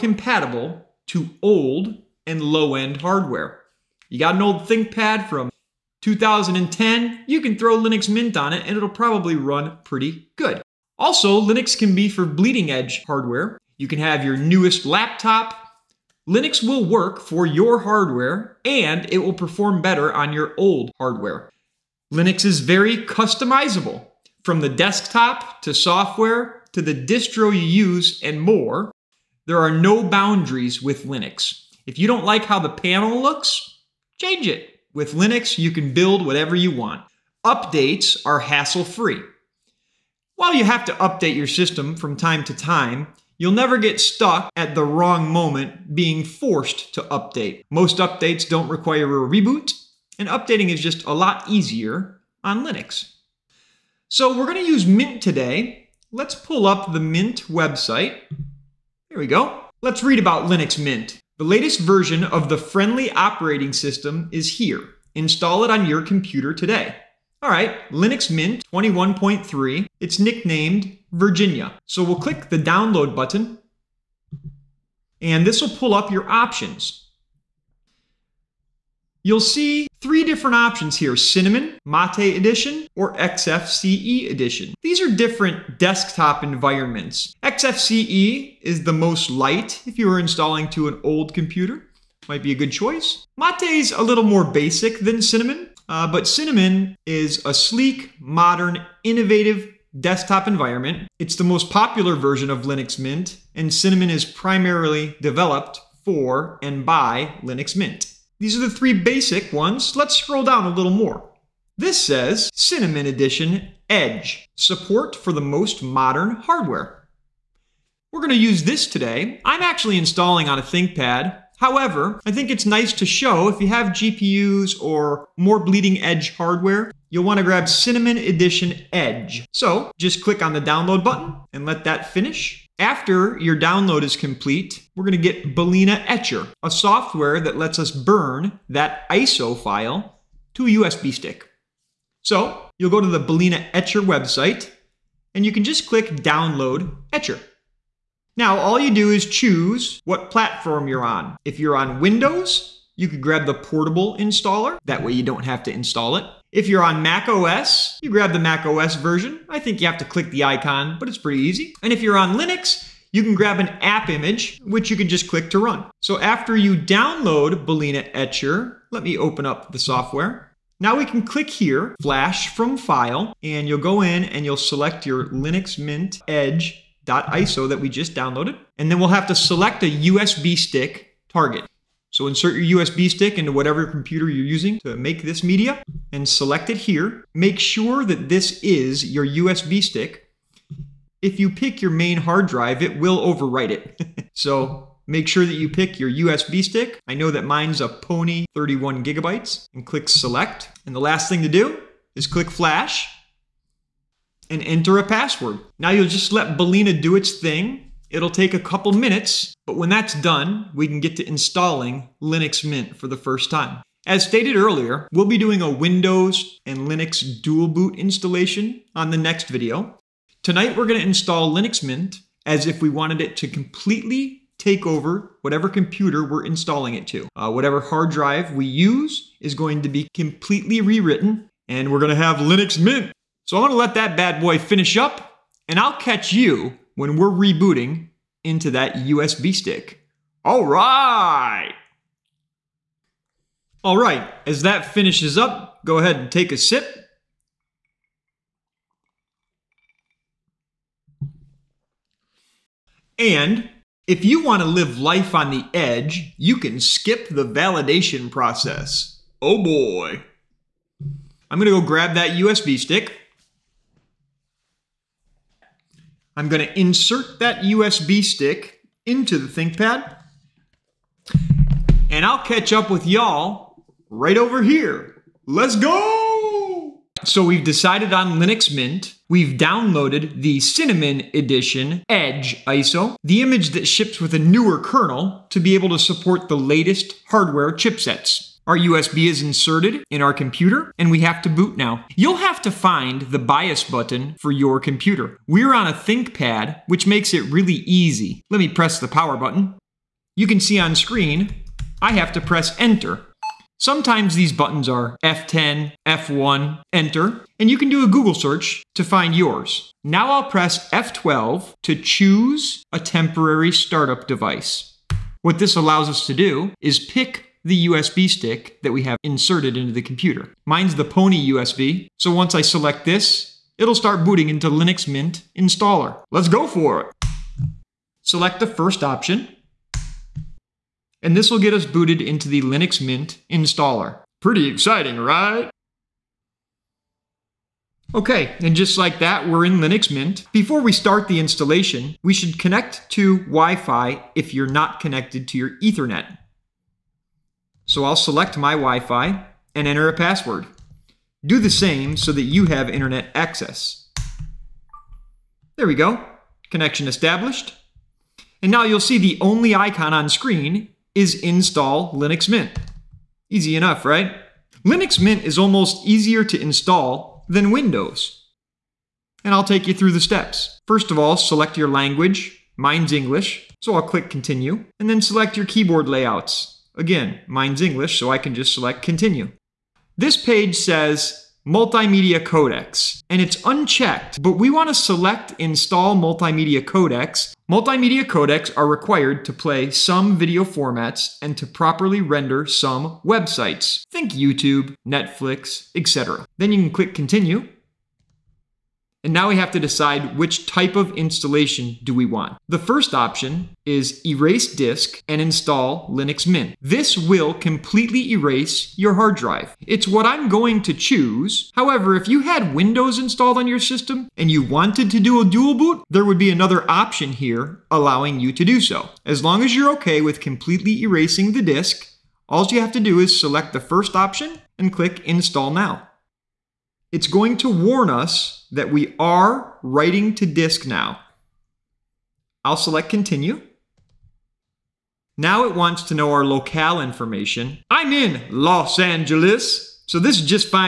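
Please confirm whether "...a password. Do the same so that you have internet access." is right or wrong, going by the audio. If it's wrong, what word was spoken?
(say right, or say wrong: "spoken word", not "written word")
right.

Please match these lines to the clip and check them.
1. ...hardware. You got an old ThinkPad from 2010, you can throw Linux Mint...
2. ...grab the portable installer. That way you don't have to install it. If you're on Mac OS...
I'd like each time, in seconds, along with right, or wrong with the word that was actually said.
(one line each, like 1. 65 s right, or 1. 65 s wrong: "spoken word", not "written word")
1. 3 s right
2. 153 s right.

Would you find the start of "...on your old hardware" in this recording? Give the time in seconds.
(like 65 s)
20 s.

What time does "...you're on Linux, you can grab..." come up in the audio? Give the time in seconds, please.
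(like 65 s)
162 s.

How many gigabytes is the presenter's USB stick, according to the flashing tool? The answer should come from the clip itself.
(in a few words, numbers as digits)
31.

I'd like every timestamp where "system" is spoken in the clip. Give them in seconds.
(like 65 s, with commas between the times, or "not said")
41 s, 63 s, 413 s.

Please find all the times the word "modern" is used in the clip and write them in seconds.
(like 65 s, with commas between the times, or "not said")
98 s, 115 s.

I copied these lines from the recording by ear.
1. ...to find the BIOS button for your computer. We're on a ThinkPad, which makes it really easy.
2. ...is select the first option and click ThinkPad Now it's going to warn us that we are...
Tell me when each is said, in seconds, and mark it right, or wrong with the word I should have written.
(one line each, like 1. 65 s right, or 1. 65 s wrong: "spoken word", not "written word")
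1. 292 s right
2. 423 s wrong: "Install", not "ThinkPad".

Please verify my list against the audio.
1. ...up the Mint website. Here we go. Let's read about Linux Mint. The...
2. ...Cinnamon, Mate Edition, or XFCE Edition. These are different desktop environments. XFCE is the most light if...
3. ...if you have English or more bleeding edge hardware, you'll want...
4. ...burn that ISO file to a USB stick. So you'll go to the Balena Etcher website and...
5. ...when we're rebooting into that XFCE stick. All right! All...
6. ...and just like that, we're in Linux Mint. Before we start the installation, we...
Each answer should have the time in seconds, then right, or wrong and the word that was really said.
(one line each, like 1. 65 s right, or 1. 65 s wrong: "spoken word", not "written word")
1. 56 s right
2. 81 s right
3. 123 s wrong: "GPUs", not "English"
4. 137 s right
5. 236 s wrong: "USB", not "XFCE"
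6. 338 s right.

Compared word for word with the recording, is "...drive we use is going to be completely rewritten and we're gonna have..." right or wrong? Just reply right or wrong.
right.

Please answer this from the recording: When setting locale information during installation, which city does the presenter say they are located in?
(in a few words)
Los Angeles.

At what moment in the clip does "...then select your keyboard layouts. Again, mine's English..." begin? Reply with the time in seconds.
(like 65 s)
375 s.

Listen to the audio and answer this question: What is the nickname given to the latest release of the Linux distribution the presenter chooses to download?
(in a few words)
Virginia.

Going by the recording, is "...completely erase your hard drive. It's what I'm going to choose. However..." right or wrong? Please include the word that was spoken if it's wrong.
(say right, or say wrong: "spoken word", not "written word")
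right.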